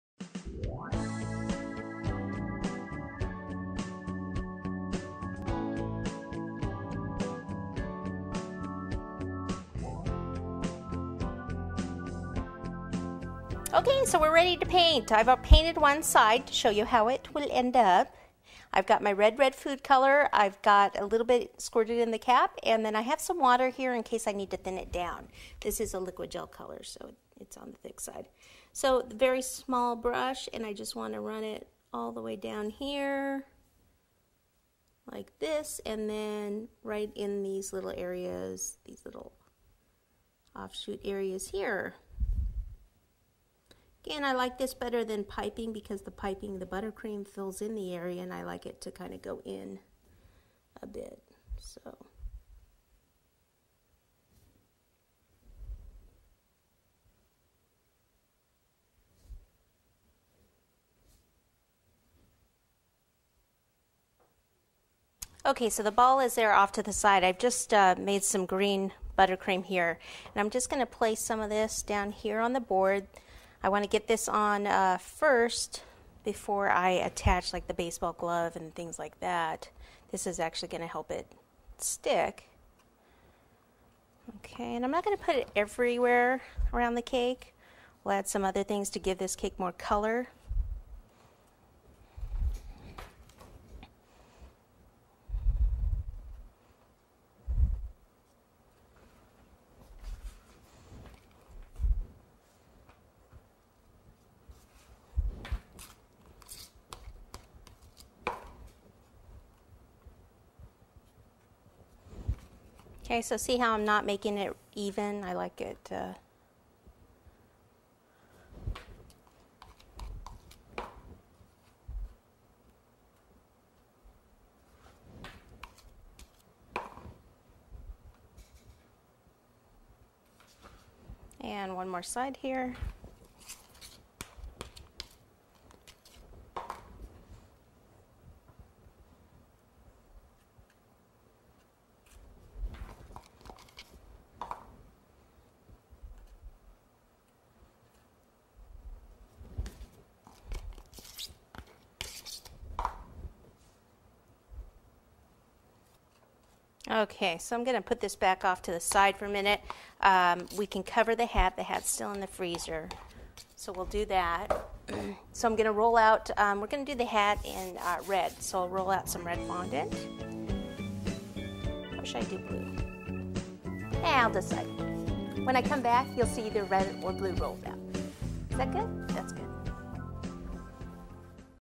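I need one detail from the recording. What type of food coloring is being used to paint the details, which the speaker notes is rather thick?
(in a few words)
Liquid gel color.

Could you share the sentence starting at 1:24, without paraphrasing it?
Okay, and I'm not going to put it everywhere around the cake.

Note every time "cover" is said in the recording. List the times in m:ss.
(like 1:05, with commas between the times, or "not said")
2:40.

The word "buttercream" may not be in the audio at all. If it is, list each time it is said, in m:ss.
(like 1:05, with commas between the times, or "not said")
0:46, 1:09.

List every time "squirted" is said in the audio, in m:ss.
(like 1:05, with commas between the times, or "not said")
0:21.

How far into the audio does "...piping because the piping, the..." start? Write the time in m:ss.
0:45.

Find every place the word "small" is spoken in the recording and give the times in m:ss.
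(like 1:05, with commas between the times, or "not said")
0:29.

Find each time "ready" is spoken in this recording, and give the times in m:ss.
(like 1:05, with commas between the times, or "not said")
0:14.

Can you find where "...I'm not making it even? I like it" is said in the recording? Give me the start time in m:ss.
1:53.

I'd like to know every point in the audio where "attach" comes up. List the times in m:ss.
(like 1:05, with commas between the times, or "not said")
1:16.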